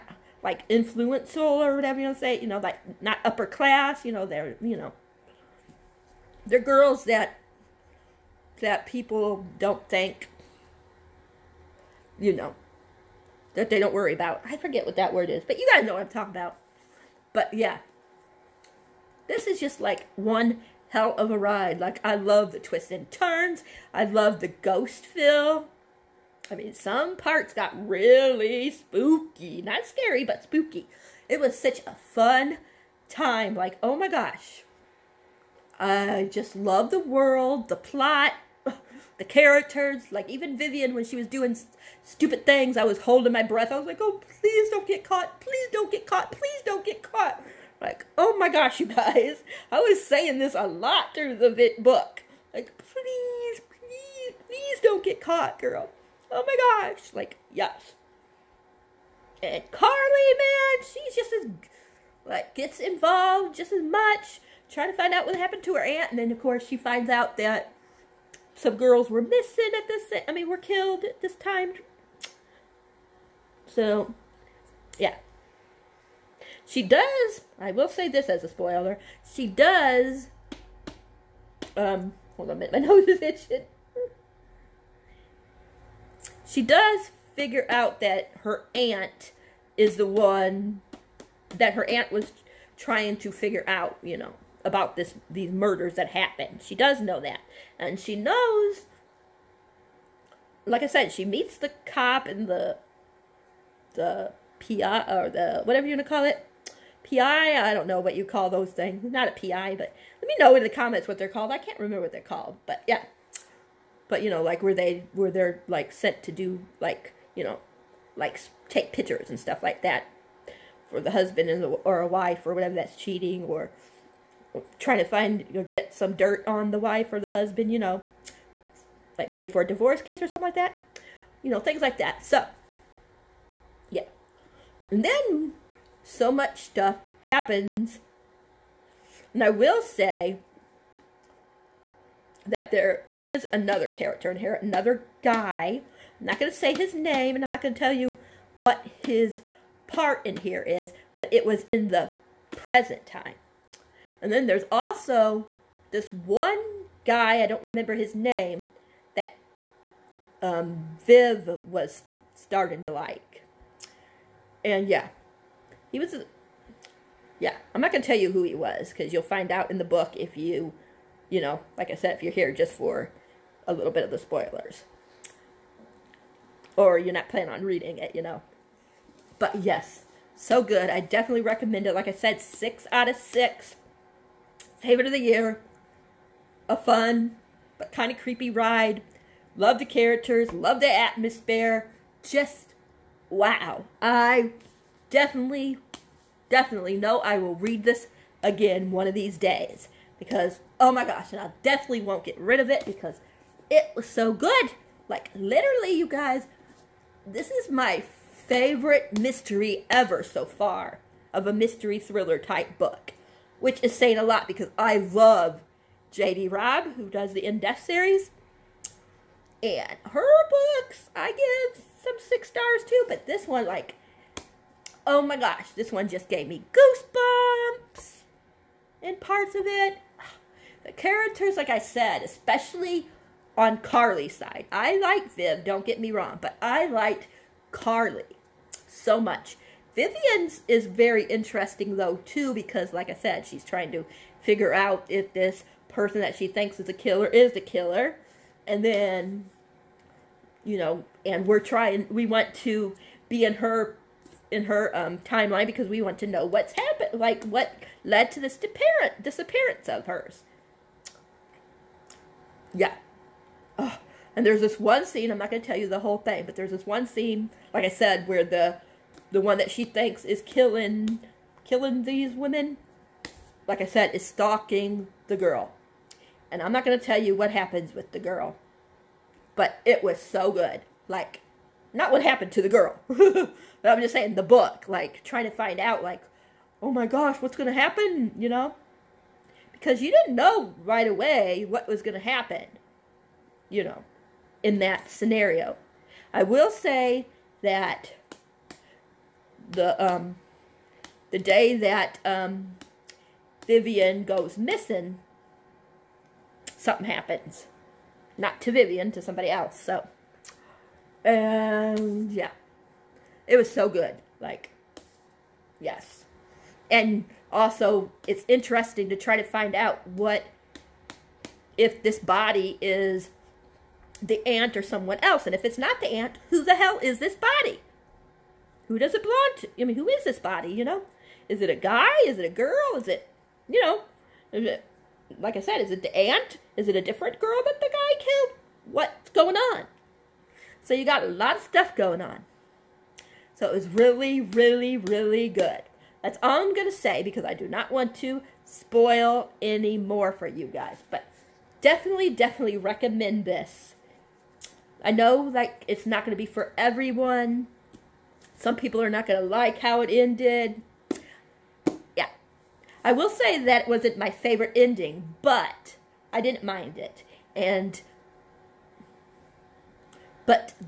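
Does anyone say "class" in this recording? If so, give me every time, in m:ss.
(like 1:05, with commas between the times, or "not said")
0:03.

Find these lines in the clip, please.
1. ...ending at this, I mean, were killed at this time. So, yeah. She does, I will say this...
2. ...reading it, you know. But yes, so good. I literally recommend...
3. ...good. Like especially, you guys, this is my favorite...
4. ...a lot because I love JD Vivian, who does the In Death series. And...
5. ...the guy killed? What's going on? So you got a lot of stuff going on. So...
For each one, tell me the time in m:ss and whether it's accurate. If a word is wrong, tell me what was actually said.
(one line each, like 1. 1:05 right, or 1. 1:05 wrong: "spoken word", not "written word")
1. 1:09 wrong: "missing", not "ending"
2. 2:57 wrong: "definitely", not "literally"
3. 3:24 wrong: "literally", not "especially"
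4. 3:34 wrong: "Robb", not "Vivian"
5. 5:37 right.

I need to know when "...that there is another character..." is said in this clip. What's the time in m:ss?
2:22.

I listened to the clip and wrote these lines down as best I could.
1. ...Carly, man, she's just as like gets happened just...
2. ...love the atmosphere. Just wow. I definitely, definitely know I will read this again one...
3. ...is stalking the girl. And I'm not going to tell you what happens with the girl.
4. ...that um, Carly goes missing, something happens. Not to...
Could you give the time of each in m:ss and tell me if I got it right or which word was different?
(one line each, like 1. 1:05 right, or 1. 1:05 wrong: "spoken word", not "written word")
1. 0:59 wrong: "involved", not "happened"
2. 3:10 right
3. 4:34 right
4. 5:01 wrong: "Vivian", not "Carly".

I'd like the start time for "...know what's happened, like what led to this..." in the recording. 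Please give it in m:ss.
4:16.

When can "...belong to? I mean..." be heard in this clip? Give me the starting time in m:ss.
5:29.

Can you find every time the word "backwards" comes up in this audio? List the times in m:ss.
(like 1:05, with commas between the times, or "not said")
not said.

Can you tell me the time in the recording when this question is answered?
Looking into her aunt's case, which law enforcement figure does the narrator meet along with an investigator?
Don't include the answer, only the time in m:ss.
1:41.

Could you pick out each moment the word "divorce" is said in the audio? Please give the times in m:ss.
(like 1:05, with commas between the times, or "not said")
2:09.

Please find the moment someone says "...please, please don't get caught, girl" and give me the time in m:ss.
0:53.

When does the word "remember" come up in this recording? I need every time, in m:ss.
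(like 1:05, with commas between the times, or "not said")
1:51, 2:37.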